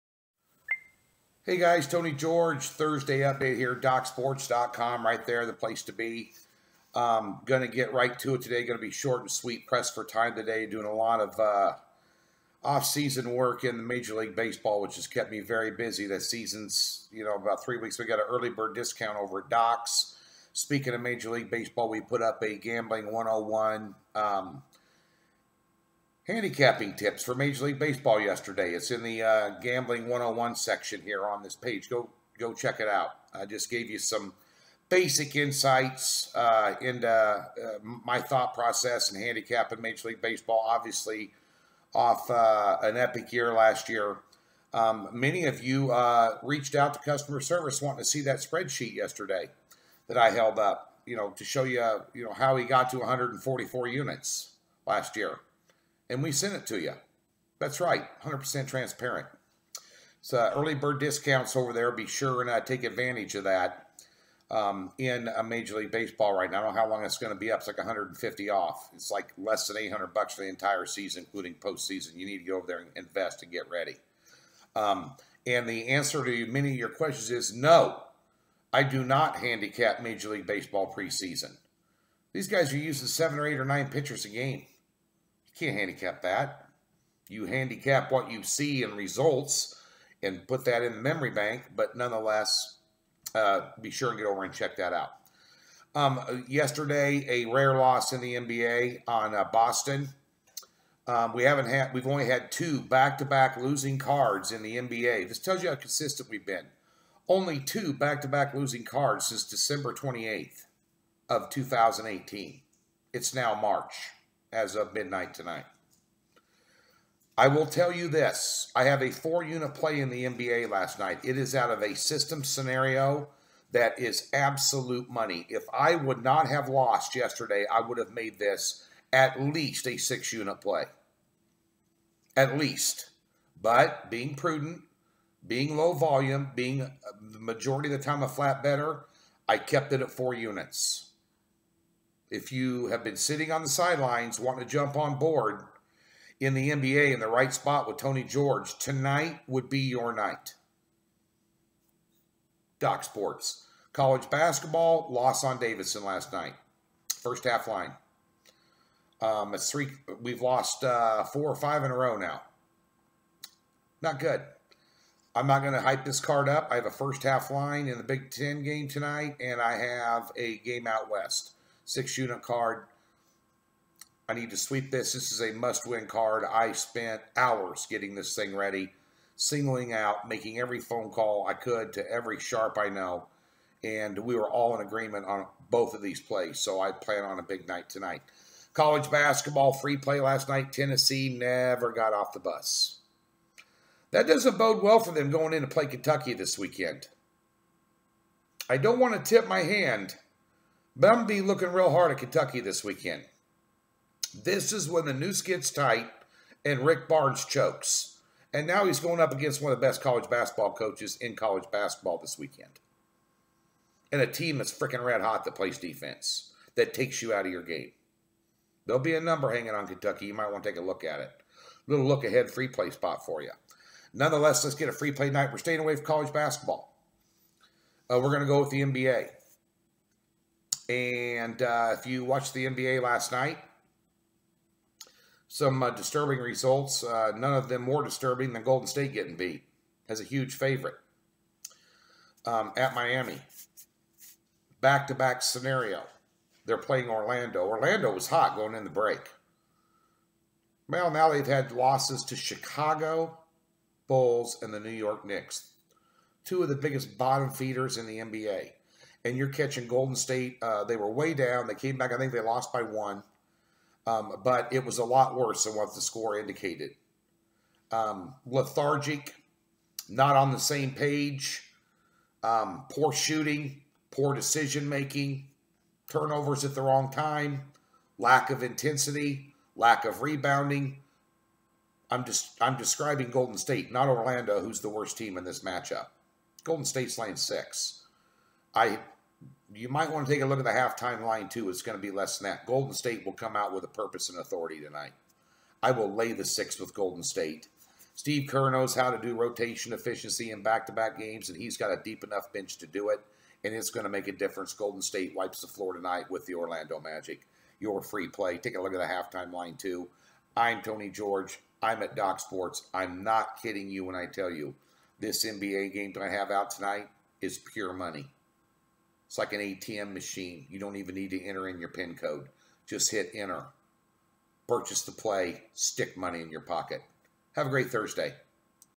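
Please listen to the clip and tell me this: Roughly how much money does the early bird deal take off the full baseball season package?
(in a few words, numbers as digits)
150.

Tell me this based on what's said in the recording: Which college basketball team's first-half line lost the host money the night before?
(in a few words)
Davidson.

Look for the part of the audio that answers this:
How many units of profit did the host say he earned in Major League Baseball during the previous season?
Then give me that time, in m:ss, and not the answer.
0:52.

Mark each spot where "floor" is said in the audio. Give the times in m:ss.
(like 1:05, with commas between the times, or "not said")
5:05.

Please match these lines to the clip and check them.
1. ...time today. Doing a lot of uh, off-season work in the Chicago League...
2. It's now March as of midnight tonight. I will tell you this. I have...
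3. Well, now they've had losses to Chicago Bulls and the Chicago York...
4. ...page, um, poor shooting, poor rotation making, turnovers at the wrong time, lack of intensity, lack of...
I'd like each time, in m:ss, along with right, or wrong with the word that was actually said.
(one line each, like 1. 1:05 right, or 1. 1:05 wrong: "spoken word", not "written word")
1. 0:10 wrong: "Major", not "Chicago"
2. 1:53 right
3. 4:10 wrong: "New", not "Chicago"
4. 4:30 wrong: "decision", not "rotation".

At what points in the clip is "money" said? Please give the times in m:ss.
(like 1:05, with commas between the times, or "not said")
2:05, 5:17, 5:26.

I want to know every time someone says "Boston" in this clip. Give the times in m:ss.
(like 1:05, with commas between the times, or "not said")
1:39.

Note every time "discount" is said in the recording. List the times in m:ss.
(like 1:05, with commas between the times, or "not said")
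0:18, 1:00.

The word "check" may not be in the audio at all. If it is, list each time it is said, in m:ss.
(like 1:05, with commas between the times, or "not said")
0:32, 1:34.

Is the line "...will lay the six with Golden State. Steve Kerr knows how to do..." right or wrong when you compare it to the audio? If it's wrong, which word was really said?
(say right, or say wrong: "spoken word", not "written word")
right.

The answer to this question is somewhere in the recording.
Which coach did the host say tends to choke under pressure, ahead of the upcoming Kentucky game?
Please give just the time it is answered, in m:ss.
3:26.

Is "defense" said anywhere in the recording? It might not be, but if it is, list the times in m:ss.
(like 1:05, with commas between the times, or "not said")
3:35.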